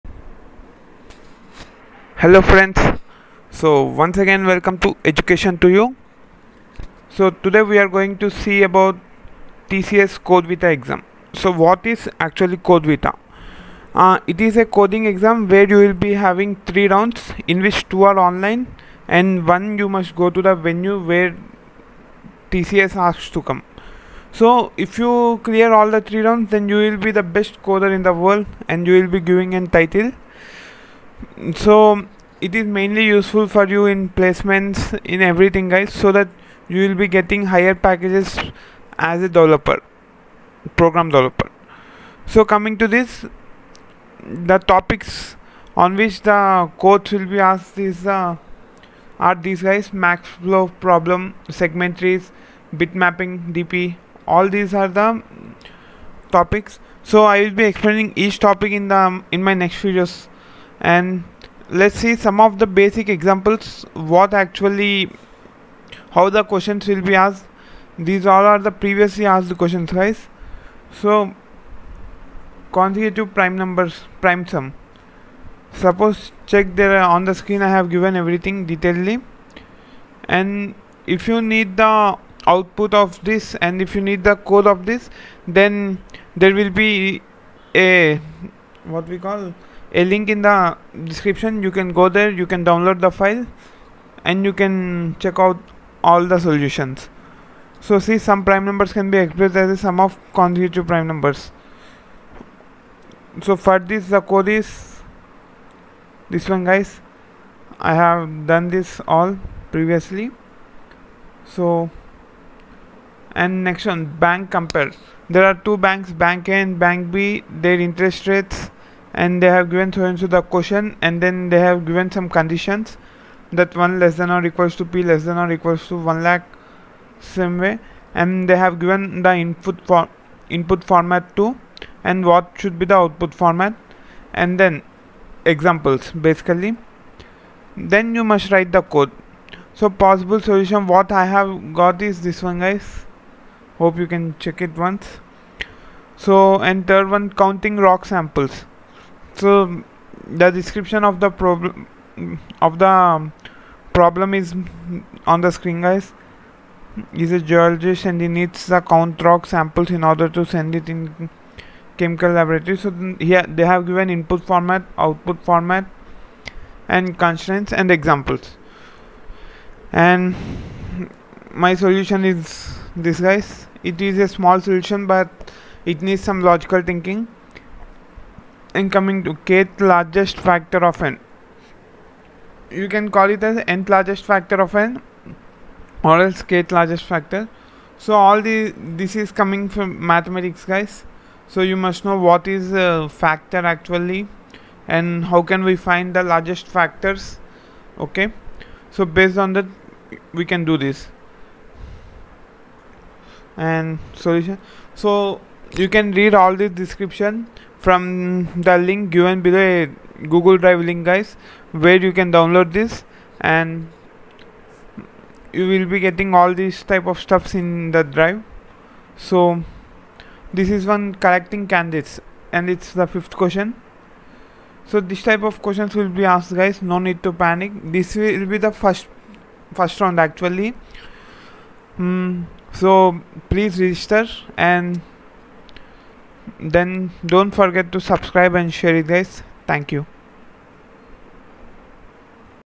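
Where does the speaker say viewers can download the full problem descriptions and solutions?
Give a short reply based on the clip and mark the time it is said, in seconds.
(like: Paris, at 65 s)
Google Drive, at 210 s.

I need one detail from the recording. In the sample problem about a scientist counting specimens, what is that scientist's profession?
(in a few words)
Geologist.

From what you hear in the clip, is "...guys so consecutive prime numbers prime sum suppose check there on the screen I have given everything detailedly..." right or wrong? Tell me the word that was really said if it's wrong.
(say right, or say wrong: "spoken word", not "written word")
right.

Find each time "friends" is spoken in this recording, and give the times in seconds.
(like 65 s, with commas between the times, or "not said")
2 s.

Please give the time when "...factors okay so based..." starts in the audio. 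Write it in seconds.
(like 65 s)
196 s.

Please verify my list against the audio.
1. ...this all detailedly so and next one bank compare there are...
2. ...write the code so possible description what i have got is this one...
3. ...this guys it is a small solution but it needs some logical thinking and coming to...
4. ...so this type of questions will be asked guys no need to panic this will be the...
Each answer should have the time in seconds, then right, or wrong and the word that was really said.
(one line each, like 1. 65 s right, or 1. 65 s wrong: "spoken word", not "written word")
1. 108 s wrong: "previously", not "detailedly"
2. 138 s wrong: "solution", not "description"
3. 172 s right
4. 224 s right.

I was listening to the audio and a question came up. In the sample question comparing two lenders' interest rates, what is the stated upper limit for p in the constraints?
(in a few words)
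1 lakh.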